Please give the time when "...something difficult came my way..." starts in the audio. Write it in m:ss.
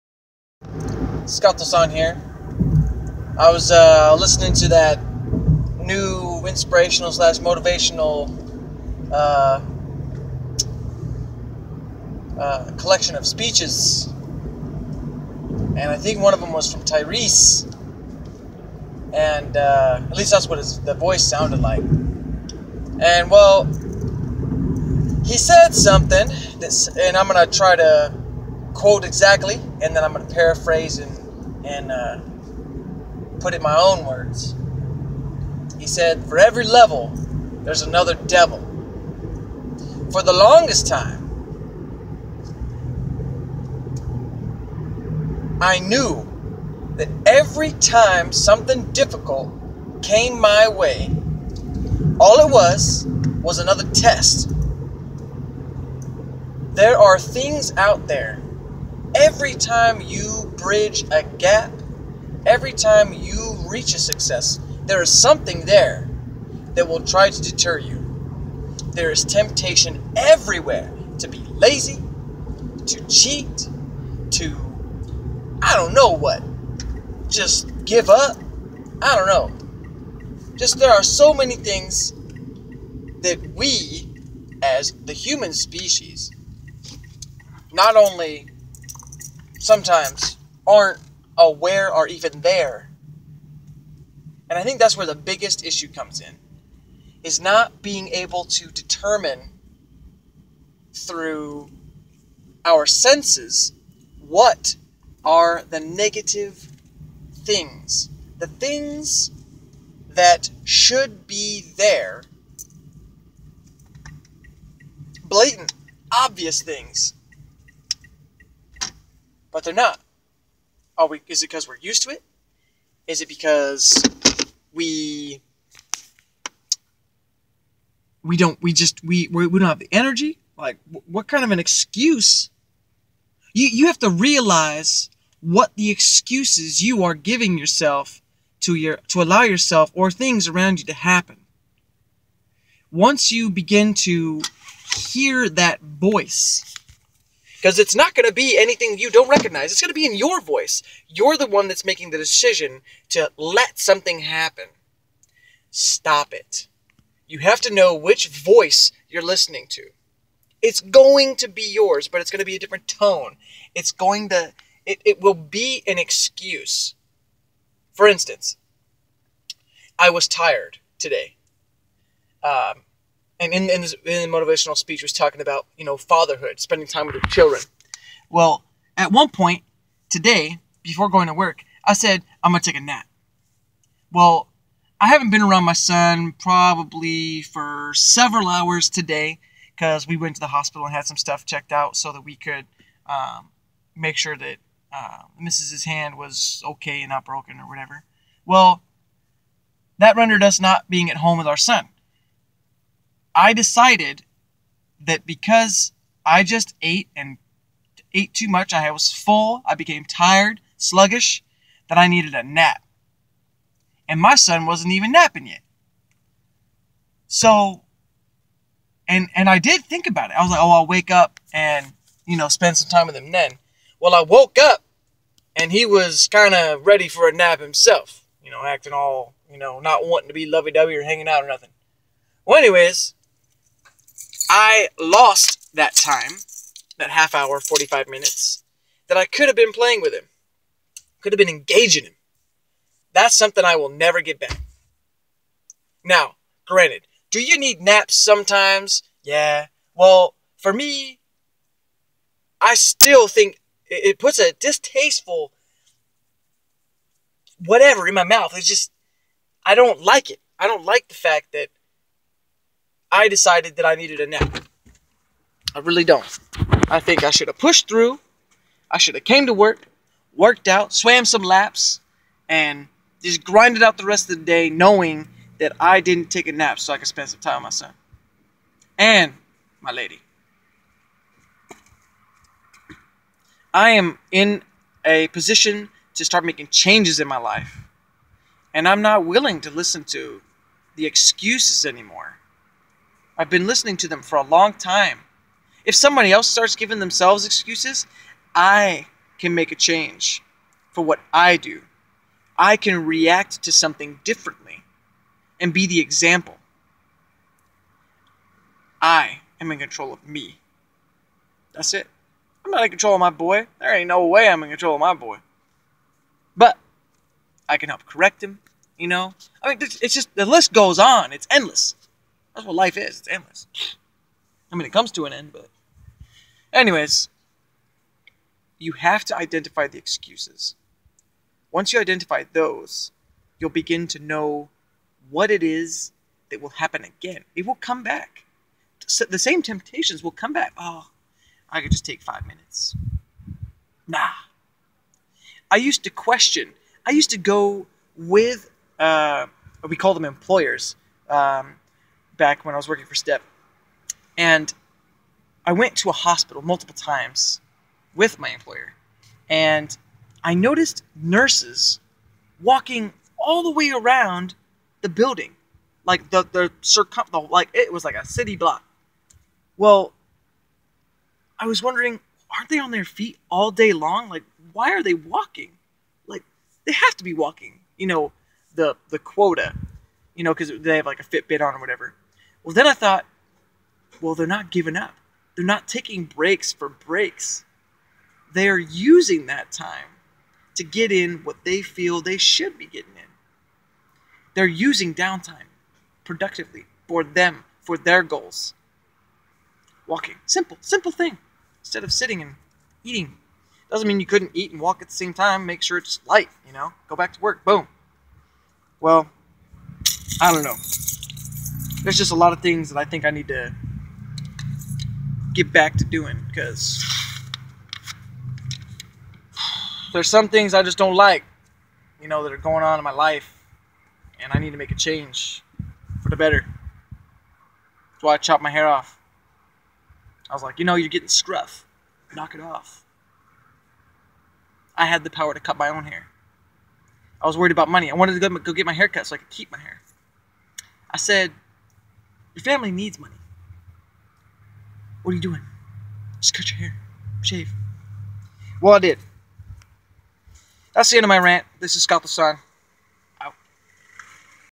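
0:48.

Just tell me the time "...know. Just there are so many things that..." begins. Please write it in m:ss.
1:19.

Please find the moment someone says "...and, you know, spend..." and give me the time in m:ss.
3:41.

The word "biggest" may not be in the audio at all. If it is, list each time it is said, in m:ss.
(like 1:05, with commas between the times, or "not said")
1:35.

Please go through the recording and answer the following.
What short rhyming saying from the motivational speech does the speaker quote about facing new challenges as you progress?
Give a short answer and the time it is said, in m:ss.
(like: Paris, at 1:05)
For every level, there's another devil, at 0:36.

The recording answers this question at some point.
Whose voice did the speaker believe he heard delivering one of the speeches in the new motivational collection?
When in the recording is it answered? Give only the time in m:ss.
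0:16.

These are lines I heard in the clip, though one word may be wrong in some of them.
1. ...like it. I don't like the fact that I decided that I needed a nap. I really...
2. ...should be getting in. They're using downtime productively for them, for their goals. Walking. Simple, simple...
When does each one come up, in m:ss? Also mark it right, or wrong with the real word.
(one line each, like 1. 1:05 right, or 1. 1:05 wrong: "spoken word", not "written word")
1. 4:20 right
2. 6:32 right.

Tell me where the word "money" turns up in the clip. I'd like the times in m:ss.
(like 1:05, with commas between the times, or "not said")
7:17, 7:23.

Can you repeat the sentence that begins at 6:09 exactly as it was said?
Well, I was wondering, aren't they on their feet all day long?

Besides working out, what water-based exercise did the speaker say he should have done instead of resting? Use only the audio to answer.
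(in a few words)
swam some laps.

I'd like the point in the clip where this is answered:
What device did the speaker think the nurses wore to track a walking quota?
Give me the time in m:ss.
6:21.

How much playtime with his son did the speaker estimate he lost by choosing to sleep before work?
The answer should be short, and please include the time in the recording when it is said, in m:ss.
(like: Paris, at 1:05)
half hour, 45 minutes, at 3:57.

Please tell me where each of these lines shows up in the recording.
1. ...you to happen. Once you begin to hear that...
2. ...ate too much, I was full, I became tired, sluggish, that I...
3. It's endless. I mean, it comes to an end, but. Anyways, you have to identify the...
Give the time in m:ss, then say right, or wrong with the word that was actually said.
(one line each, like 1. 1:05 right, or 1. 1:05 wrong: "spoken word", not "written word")
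1. 2:20 right
2. 3:28 right
3. 5:23 right.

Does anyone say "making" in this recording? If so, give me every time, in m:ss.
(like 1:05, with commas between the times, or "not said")
2:31, 4:46.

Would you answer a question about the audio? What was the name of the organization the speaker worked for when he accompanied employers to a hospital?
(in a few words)
Step.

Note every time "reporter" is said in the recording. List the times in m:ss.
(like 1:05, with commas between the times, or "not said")
not said.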